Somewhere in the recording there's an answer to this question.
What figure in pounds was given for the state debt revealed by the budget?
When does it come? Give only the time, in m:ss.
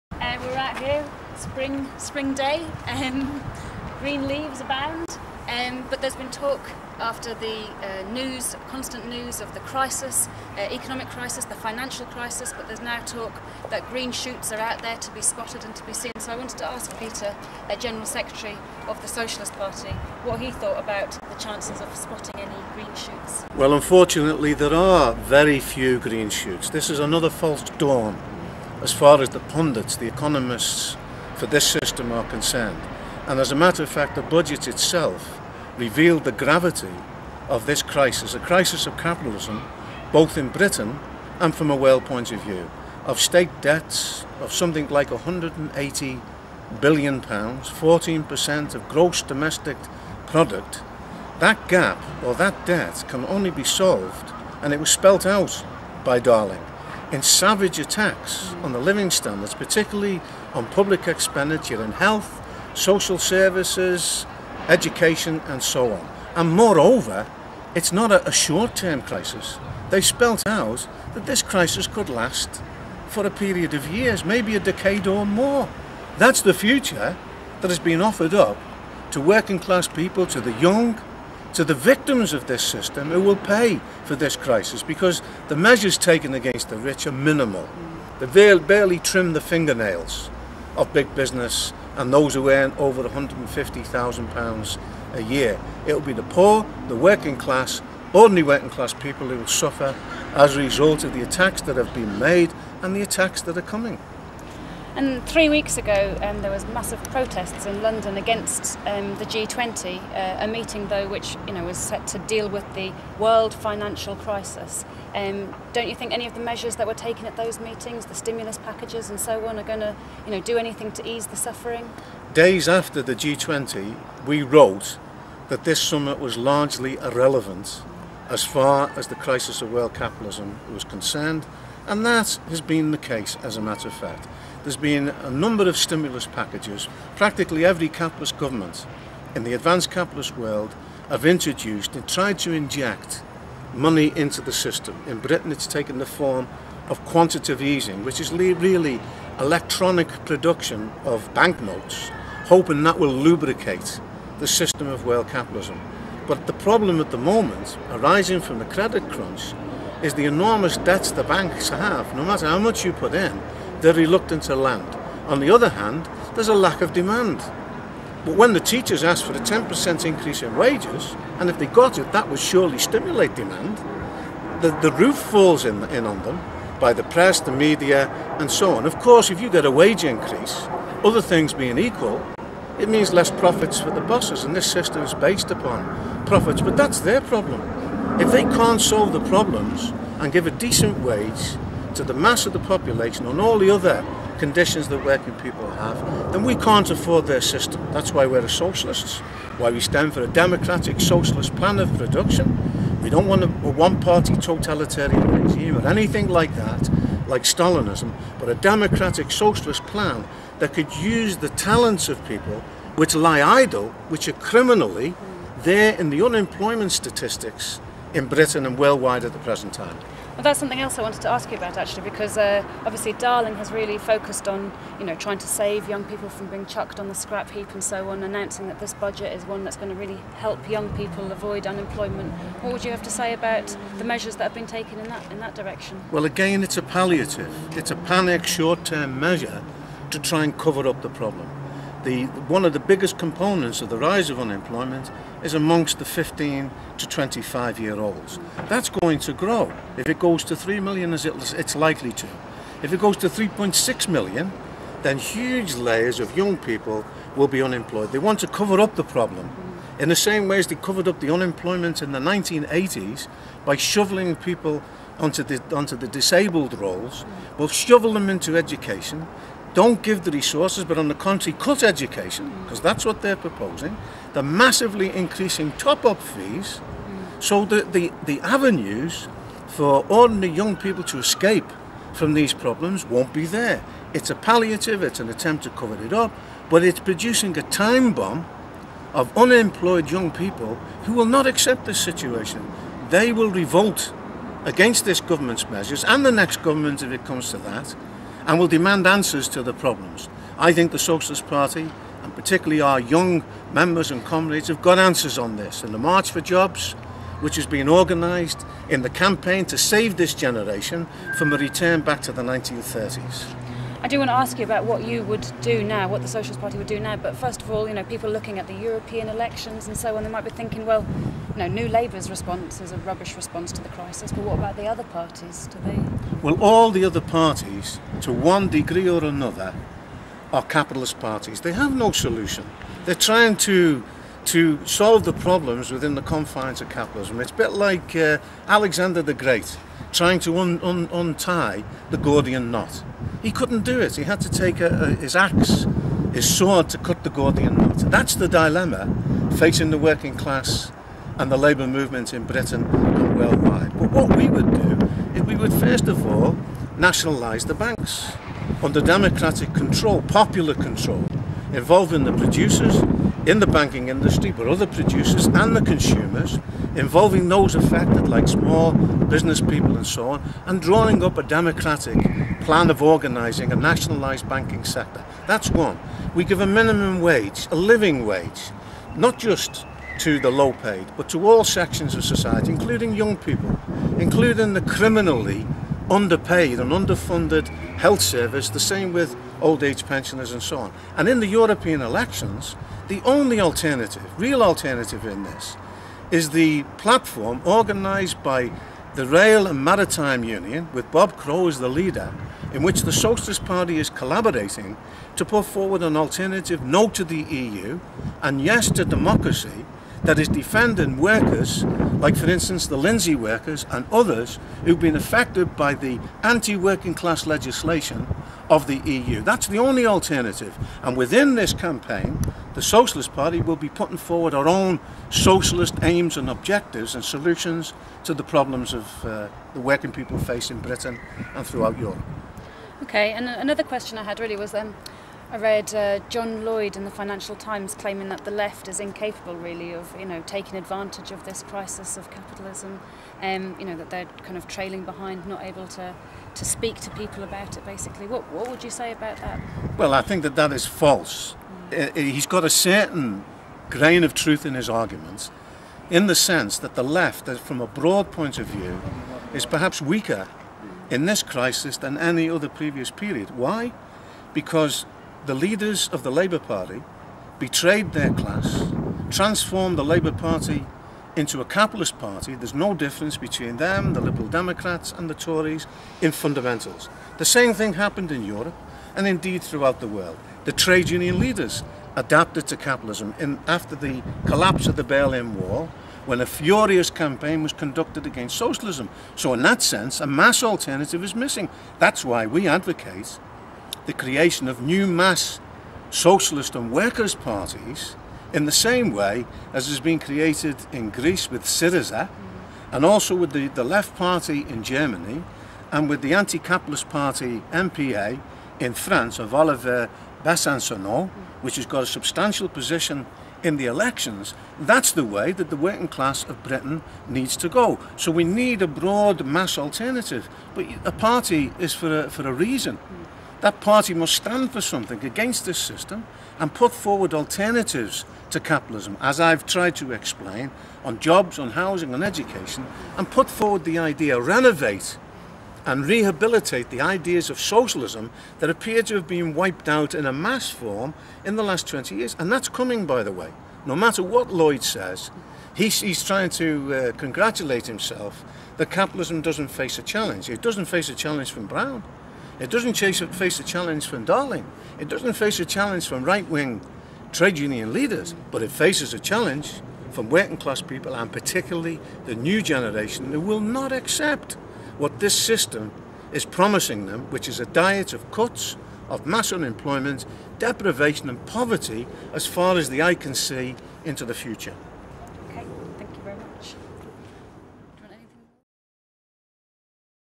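0:45.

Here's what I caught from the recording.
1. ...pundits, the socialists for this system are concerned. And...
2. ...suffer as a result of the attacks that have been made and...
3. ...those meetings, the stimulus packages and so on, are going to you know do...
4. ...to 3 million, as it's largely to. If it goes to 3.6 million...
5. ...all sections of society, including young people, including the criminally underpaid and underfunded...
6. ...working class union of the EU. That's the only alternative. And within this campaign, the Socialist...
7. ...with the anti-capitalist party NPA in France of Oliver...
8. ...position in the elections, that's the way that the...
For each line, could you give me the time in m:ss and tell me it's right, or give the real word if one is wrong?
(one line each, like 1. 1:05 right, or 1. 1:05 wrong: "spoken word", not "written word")
1. 0:29 wrong: "economists", not "socialists"
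2. 1:39 right
3. 1:57 right
4. 4:10 wrong: "likely", not "largely"
5. 6:21 right
6. 6:56 wrong: "legislation", not "union"
7. 8:26 right
8. 8:32 right.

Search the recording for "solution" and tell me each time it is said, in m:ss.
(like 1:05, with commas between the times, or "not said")
5:32, 7:07.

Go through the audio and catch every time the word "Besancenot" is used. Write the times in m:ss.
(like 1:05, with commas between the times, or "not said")
8:30.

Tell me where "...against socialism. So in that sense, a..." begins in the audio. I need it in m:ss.
8:08.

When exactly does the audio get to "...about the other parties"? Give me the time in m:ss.
5:24.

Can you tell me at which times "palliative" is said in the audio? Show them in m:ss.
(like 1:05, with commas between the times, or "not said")
3:56, 4:44.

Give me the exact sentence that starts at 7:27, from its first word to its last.
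Basically, what what would you say about that?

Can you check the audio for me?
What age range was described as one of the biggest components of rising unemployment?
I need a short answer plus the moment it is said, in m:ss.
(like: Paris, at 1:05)
15 to 25, at 4:06.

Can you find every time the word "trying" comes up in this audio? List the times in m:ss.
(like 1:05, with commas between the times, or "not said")
3:45, 5:33, 5:40, 9:06.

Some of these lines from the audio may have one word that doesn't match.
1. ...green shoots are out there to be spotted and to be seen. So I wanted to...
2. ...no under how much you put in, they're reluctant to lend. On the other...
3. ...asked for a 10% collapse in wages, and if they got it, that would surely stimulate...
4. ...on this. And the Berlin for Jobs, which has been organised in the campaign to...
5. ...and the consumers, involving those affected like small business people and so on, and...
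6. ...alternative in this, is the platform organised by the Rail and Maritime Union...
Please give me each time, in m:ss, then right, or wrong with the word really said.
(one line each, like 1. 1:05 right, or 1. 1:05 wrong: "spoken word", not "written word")
1. 0:13 right
2. 2:42 wrong: "matter", not "under"
3. 2:49 wrong: "increase", not "collapse"
4. 5:05 wrong: "March", not "Berlin"
5. 6:05 right
6. 6:34 right.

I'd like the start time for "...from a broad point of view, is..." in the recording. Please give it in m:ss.
7:37.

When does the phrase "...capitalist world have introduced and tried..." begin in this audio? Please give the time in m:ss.
2:19.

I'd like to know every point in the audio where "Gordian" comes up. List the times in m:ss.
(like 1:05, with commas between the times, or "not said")
5:42, 5:47.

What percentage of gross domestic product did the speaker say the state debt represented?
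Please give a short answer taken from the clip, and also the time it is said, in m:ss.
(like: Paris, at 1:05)
14%, at 0:47.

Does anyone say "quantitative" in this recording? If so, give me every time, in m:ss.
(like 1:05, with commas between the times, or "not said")
2:27.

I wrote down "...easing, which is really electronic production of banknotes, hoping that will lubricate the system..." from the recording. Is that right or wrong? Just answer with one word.
right.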